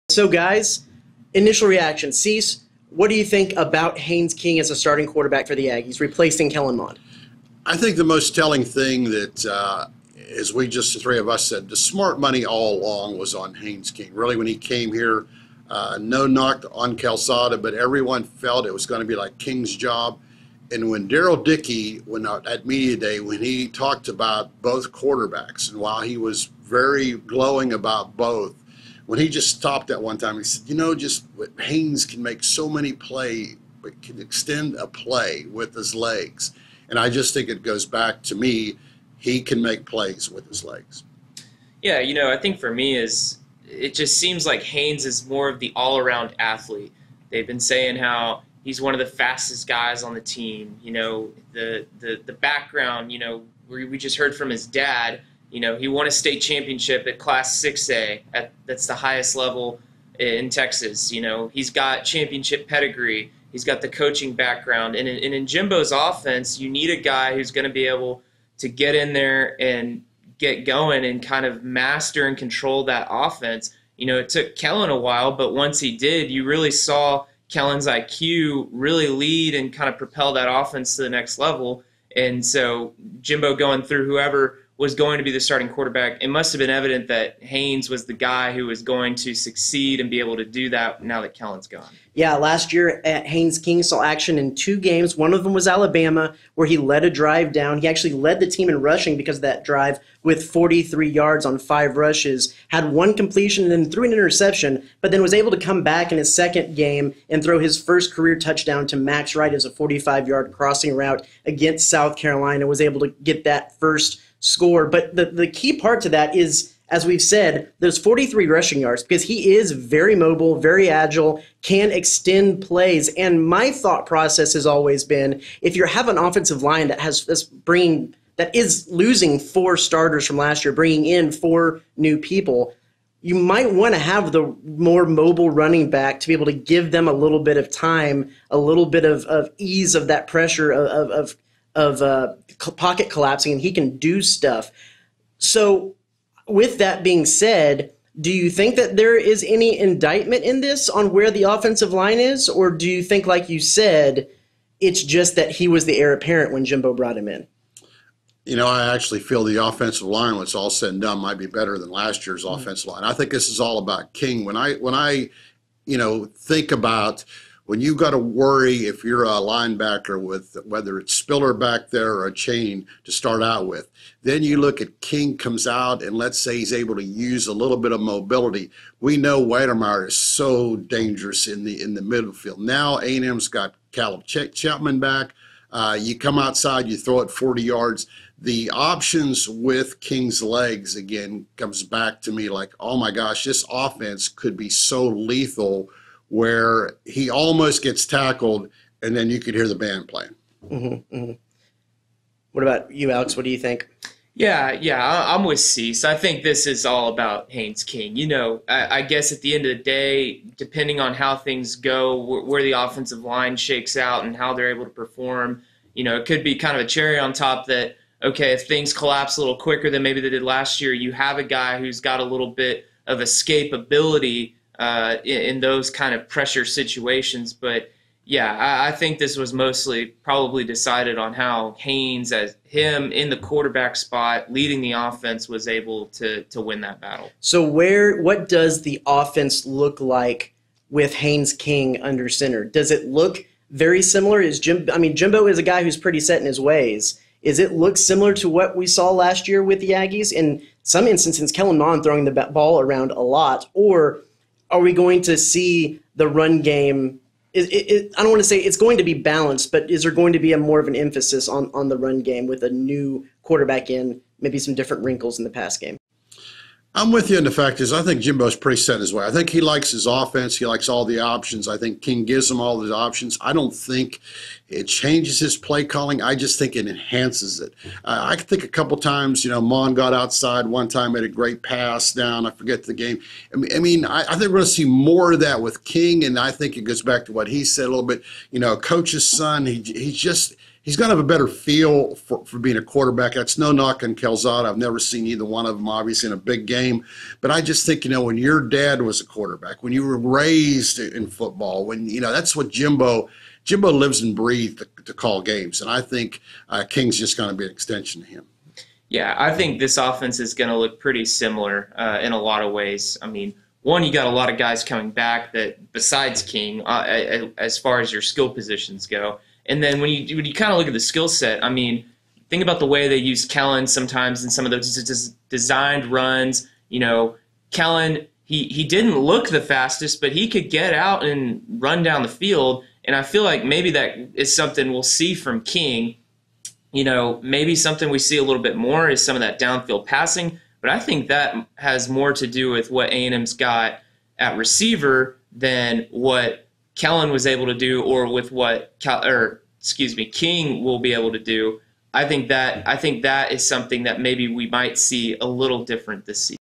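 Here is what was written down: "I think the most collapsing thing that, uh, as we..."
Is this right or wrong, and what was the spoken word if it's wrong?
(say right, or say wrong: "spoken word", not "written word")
wrong: "telling", not "collapsing".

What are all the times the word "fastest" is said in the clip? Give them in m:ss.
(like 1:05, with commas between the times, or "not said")
0:49, 5:29.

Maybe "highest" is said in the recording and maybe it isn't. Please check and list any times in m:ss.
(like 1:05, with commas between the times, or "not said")
0:58.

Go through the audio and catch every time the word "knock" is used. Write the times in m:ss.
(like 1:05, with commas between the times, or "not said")
0:16, 4:53.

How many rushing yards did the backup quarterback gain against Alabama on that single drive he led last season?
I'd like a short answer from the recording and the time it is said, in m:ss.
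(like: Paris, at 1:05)
43, at 1:40.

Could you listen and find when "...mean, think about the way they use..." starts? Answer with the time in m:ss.
5:21.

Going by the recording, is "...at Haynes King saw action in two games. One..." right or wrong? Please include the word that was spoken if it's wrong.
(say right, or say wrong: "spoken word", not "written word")
right.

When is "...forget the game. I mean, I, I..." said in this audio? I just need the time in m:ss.
4:42.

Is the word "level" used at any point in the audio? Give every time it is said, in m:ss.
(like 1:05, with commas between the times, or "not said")
0:59, 1:21.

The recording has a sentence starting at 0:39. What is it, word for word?
He can make plays with his legs.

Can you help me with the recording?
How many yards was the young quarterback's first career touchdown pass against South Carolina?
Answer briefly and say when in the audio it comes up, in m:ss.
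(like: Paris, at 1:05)
45, at 1:49.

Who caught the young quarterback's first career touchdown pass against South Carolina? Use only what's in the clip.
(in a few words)
Max Wright.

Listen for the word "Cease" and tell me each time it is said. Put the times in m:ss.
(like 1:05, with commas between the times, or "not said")
0:02, 3:25.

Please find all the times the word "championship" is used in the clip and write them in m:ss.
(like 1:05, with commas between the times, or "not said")
0:56, 1:02.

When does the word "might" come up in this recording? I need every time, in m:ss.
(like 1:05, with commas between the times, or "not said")
2:13, 2:41, 5:54.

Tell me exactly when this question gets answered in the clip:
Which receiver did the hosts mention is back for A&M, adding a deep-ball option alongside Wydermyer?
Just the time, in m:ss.
3:03.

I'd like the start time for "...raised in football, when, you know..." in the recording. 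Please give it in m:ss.
5:00.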